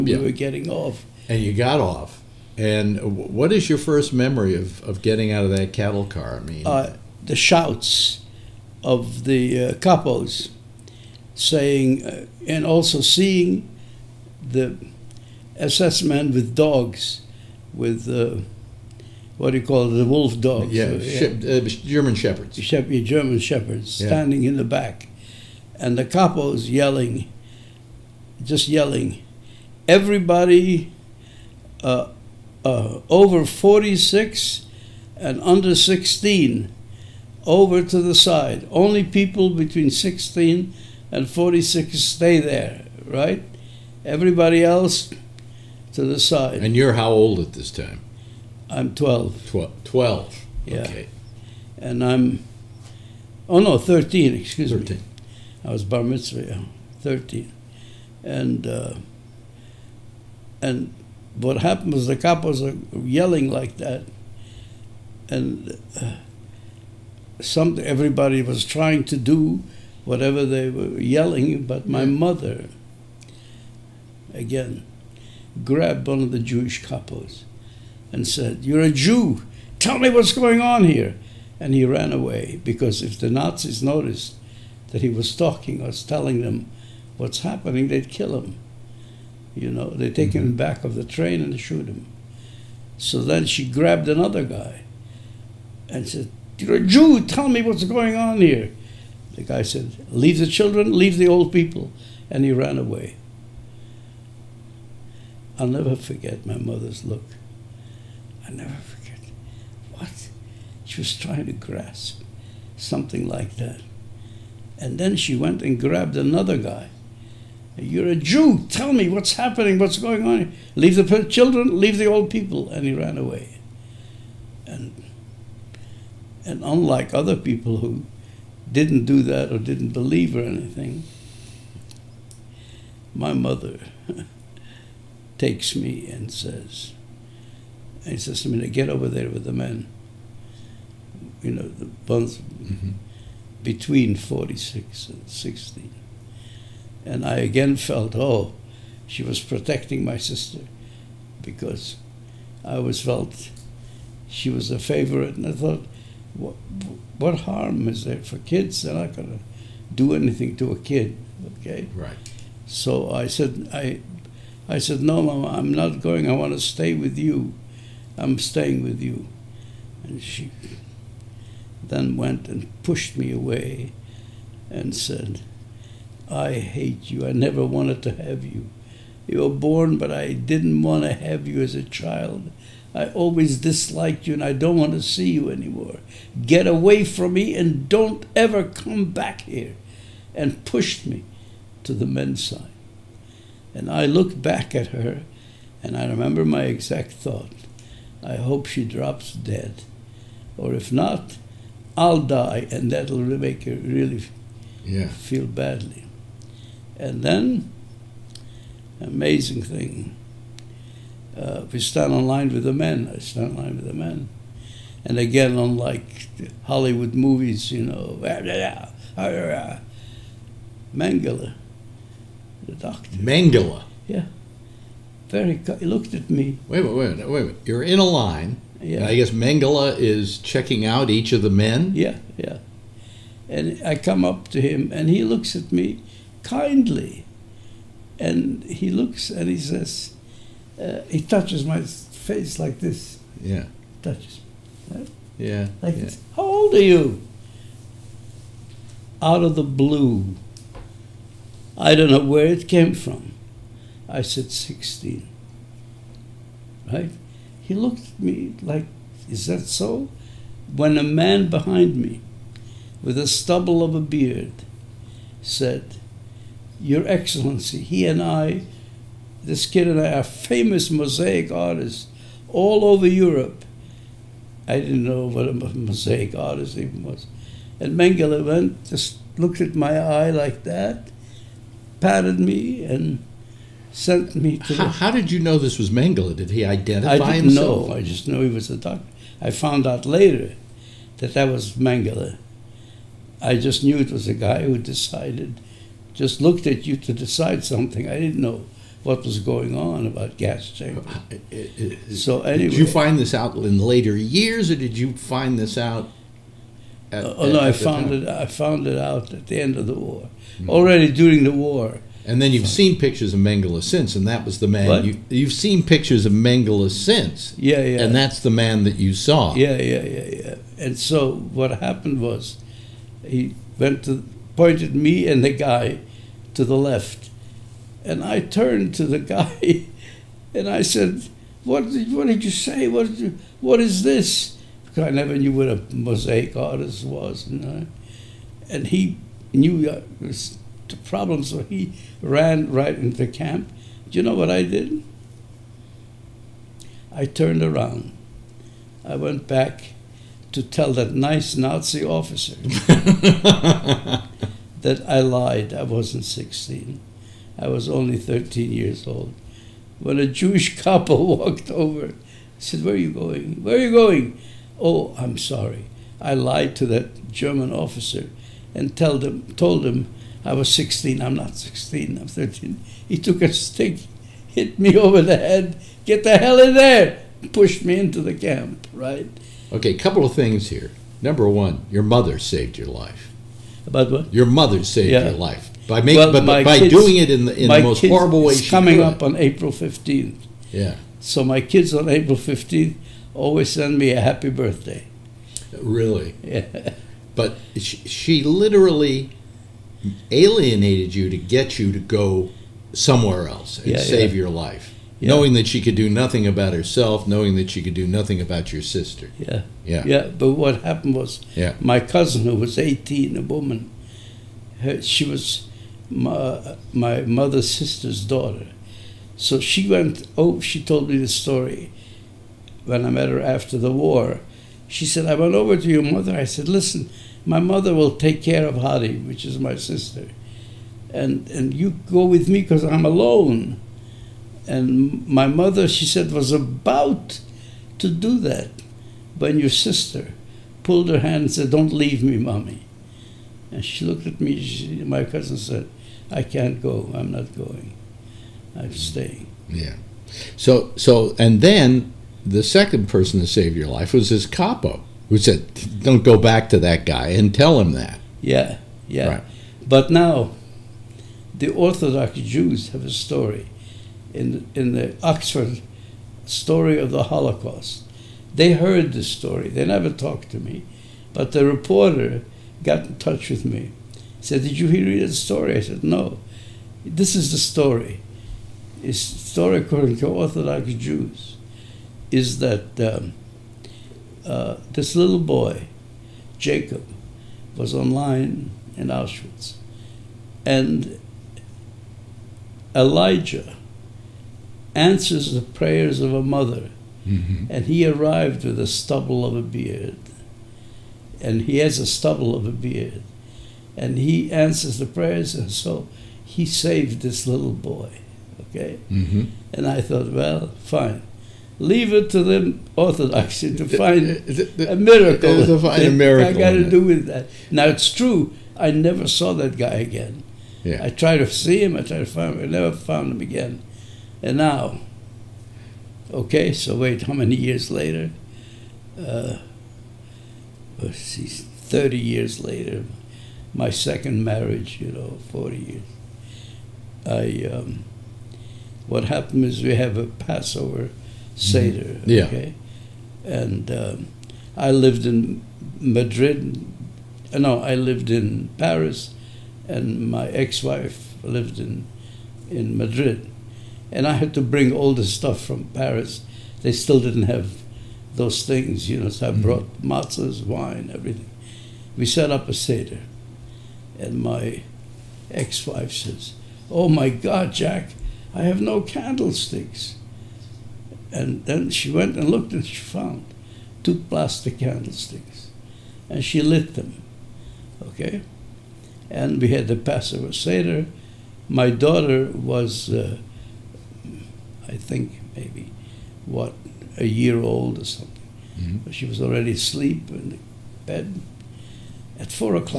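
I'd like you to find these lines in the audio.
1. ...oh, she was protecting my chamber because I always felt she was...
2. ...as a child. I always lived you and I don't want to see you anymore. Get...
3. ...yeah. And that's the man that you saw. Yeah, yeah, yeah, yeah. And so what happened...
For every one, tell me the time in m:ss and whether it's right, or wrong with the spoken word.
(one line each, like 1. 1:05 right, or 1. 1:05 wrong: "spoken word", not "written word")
1. 2:28 wrong: "sister", not "chamber"
2. 3:01 wrong: "disliked", not "lived"
3. 5:17 right.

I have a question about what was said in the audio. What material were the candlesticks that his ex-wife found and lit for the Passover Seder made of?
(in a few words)
plastic.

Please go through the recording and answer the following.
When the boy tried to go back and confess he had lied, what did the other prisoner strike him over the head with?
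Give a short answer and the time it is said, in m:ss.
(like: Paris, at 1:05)
a stick, at 6:13.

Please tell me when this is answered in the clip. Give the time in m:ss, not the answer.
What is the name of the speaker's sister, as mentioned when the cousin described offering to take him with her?
7:08.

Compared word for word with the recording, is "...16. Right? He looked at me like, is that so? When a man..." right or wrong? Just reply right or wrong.
right.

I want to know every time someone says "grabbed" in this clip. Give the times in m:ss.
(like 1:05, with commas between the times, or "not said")
1:15, 1:33, 1:55.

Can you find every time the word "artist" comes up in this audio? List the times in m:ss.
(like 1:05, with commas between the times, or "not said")
4:31, 4:36, 5:36.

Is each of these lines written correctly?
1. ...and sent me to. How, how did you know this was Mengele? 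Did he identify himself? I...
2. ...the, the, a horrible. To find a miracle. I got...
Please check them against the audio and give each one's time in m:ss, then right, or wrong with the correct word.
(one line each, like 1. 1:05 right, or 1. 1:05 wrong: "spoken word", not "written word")
1. 4:42 right
2. 8:34 wrong: "miracle", not "horrible".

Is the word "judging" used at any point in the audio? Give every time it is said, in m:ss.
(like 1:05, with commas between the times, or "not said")
not said.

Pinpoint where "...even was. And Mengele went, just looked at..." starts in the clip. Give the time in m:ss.
4:36.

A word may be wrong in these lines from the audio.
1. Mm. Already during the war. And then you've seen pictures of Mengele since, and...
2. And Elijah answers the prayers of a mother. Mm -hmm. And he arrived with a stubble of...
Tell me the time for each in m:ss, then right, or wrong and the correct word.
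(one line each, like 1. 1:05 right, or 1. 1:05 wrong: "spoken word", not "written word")
1. 5:10 right
2. 8:10 right.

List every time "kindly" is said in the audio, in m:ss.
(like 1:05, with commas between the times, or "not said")
3:56.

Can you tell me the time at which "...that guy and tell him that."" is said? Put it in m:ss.
7:36.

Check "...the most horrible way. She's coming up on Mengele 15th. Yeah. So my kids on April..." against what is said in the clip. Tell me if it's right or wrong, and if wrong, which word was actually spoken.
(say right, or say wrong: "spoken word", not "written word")
wrong: "April", not "Mengele".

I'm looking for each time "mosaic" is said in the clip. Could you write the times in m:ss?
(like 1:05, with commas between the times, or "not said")
4:30, 4:35, 5:35.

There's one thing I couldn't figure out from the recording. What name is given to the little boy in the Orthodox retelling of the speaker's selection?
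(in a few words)
Jacob.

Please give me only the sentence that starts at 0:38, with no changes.
Only people between 16 and 46 stay there, right?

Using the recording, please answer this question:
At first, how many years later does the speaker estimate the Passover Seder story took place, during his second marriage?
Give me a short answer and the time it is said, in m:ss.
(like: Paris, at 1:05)
30, at 8:51.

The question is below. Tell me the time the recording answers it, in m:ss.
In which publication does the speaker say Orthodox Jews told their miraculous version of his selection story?
7:45.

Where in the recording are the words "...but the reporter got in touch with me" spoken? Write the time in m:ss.
7:51.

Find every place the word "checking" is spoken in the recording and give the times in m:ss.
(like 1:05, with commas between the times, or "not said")
3:50.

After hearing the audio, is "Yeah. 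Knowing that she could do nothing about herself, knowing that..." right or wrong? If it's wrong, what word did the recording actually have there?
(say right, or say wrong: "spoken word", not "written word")
right.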